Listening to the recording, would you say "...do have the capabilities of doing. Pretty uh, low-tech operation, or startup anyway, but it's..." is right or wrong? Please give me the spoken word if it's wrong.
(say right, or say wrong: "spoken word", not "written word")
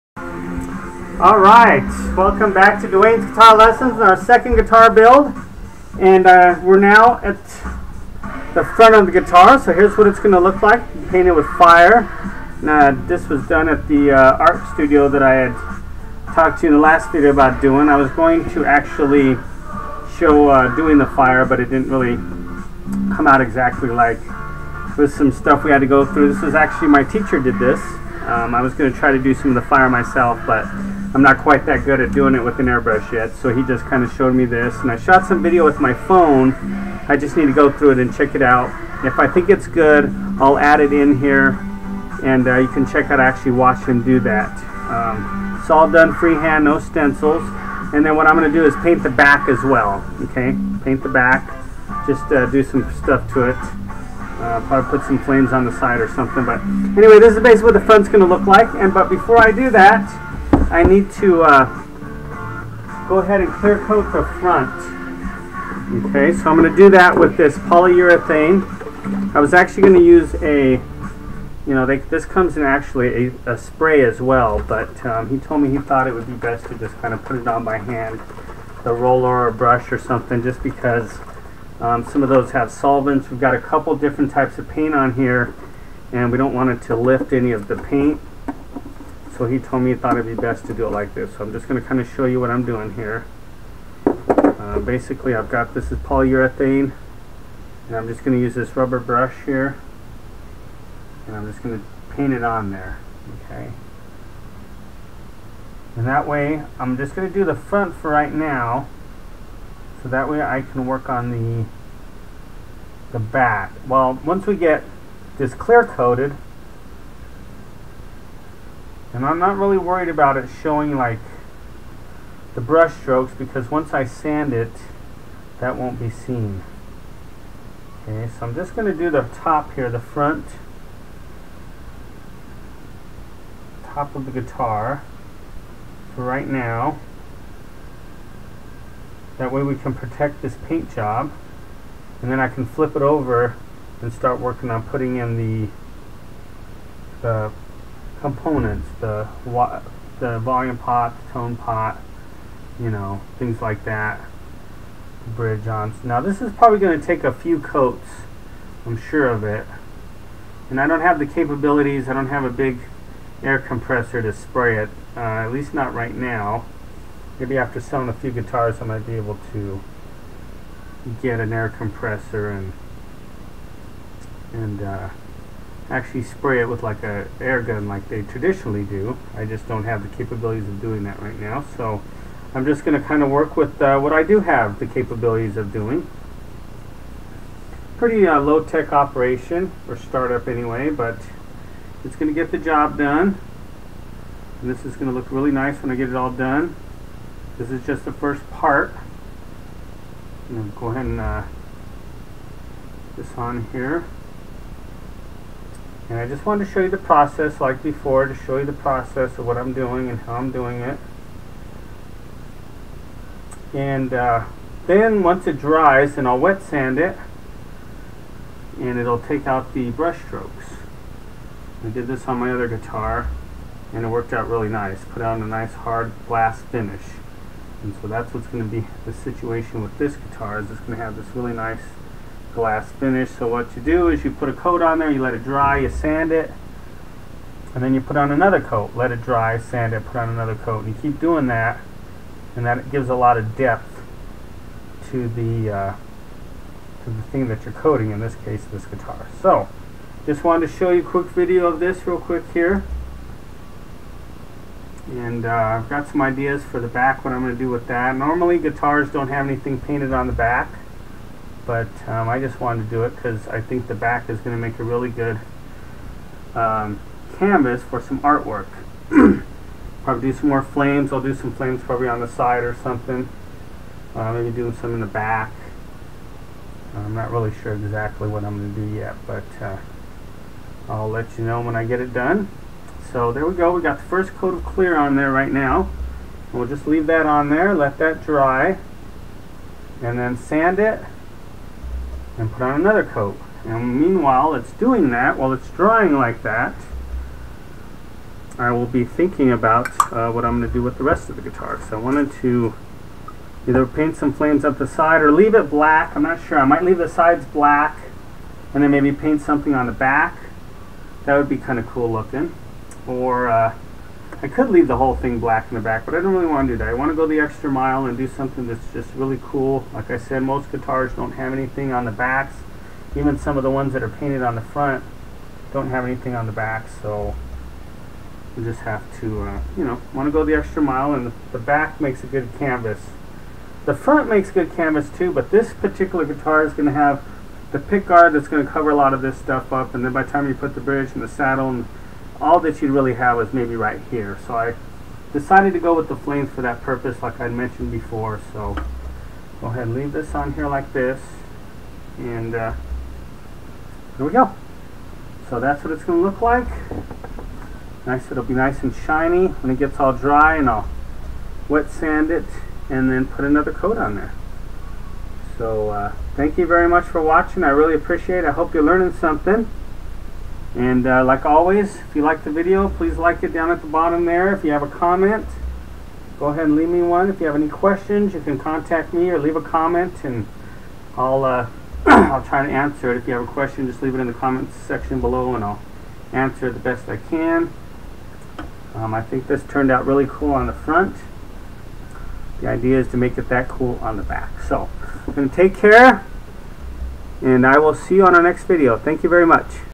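right.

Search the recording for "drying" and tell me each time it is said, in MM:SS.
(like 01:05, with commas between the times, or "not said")
04:55.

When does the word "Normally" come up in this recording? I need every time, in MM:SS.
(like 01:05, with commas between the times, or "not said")
04:18.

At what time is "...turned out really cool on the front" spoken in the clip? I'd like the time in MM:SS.
06:29.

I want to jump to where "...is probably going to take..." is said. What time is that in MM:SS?
02:36.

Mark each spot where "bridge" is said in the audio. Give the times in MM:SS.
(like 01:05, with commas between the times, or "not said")
02:35, 05:40.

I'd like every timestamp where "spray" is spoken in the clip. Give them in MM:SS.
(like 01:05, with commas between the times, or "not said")
01:13, 02:44, 02:56.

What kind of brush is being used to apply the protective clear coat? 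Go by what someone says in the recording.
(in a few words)
Rubber brush.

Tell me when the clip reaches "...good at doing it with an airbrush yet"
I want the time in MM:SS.
00:31.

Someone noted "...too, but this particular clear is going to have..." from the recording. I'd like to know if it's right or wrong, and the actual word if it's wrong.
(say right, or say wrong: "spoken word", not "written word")
wrong: "guitar", not "clear".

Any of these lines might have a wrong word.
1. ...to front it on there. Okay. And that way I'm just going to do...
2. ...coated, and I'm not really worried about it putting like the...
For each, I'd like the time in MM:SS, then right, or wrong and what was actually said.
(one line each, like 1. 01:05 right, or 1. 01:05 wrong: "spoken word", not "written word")
1. 01:41 wrong: "paint", not "front"
2. 01:55 wrong: "showing", not "putting".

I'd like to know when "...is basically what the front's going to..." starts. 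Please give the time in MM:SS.
00:57.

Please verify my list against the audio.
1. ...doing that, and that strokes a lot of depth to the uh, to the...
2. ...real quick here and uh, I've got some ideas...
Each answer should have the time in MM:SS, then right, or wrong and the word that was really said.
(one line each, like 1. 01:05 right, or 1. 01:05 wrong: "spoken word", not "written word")
1. 04:01 wrong: "gives", not "strokes"
2. 04:12 right.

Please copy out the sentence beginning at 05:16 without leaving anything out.
I want to go the extra mile and do something that's just really cool.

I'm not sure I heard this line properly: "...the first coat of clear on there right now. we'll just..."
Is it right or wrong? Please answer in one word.
right.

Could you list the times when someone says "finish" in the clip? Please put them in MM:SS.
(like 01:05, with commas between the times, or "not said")
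03:46, 03:52.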